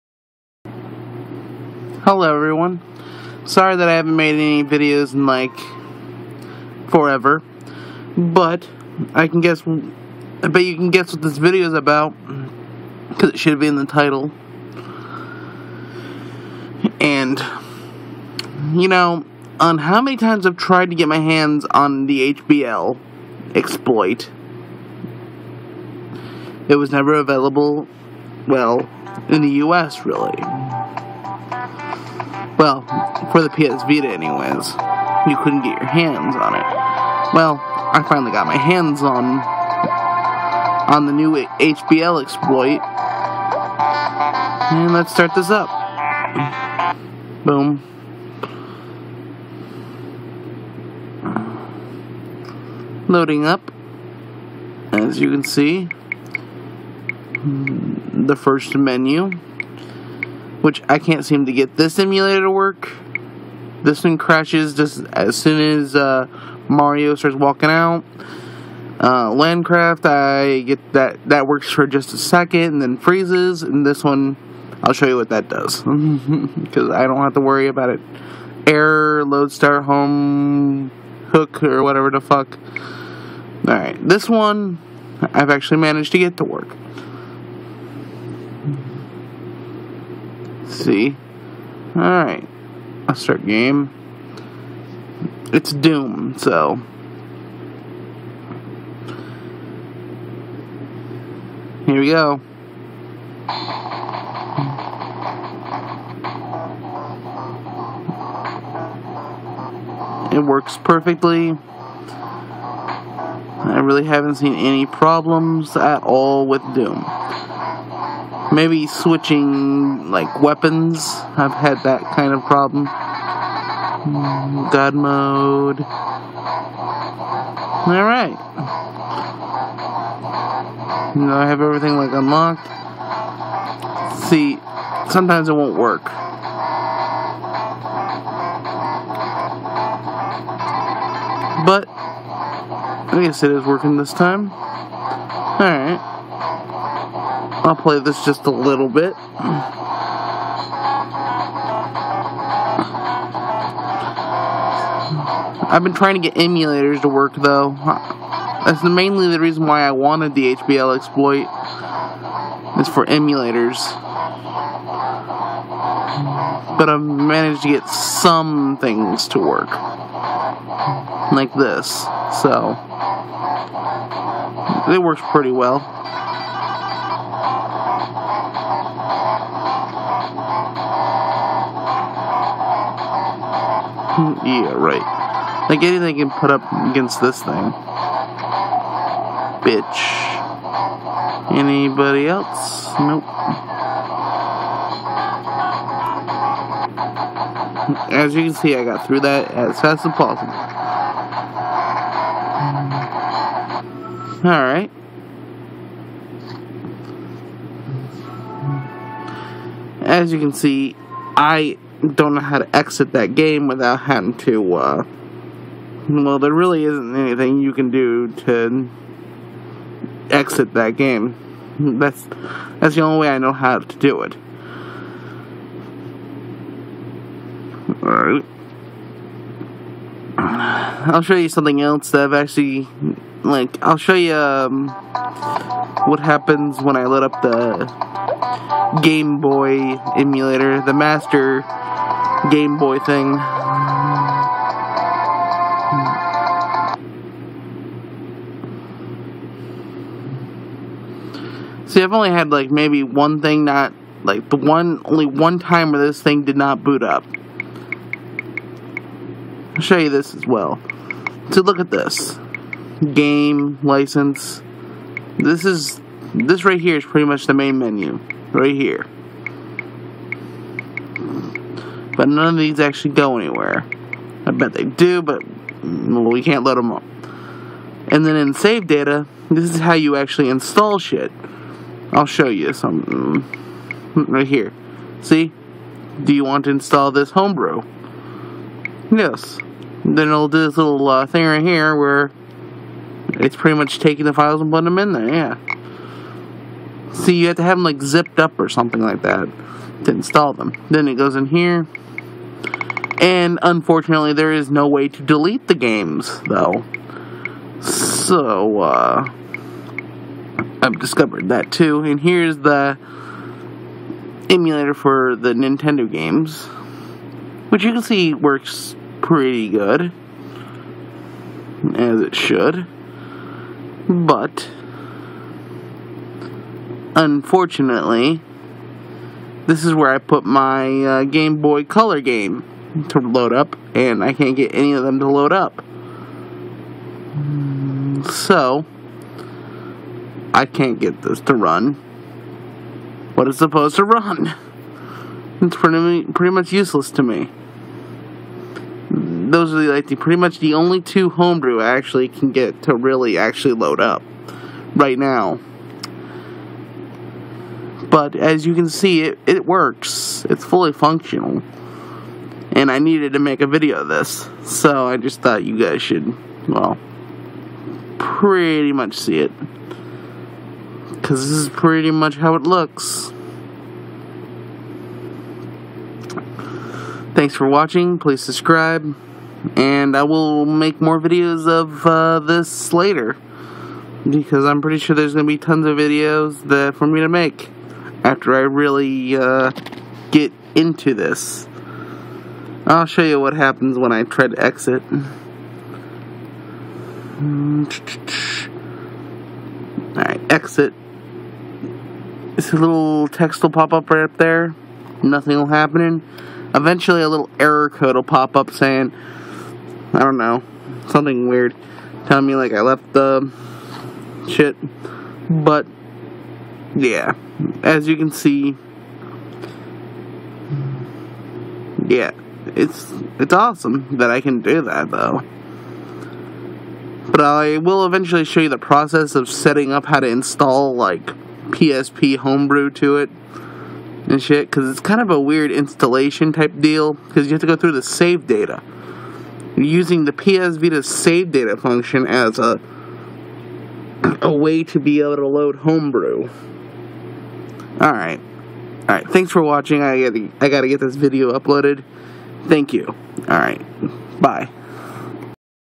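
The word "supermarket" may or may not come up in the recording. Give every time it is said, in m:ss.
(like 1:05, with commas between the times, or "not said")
not said.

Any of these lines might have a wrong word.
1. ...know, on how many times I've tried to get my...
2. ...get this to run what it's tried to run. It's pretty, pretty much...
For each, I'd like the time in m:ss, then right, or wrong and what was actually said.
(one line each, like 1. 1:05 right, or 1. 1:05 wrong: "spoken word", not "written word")
1. 0:18 right
2. 5:40 wrong: "supposed", not "tried".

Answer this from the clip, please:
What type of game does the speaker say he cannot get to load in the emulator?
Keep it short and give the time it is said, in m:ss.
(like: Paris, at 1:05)
Game Boy Color, at 5:31.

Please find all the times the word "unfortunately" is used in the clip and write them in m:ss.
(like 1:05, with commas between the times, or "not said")
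5:03, 5:27.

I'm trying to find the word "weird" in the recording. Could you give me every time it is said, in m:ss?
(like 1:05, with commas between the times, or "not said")
6:51, 7:15.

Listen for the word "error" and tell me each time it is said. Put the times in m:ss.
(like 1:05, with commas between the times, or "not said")
1:18, 6:47.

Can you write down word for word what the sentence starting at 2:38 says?
That's mainly the reason why I wanted the HBL exploit.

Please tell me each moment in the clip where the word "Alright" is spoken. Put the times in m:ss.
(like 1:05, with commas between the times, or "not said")
1:23, 1:31, 2:24, 3:24, 3:48, 6:37.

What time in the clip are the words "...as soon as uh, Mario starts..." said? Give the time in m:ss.
1:05.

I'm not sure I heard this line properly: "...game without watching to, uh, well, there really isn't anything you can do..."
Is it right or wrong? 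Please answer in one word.
wrong.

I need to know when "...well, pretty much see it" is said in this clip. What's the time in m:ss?
6:06.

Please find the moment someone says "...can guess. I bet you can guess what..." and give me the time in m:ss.
0:09.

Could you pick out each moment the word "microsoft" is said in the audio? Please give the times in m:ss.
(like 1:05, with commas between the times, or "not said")
not said.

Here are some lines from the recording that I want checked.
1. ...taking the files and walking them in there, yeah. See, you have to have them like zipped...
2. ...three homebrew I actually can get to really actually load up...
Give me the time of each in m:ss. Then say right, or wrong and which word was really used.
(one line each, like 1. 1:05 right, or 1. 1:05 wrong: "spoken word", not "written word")
1. 4:53 wrong: "putting", not "walking"
2. 5:51 wrong: "two", not "three".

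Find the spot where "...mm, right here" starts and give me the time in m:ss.
4:44.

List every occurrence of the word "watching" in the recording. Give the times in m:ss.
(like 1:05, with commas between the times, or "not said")
6:17, 7:29.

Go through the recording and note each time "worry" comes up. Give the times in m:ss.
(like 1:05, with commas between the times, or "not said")
1:17.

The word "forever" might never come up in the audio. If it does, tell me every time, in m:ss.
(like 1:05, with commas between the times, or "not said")
0:06.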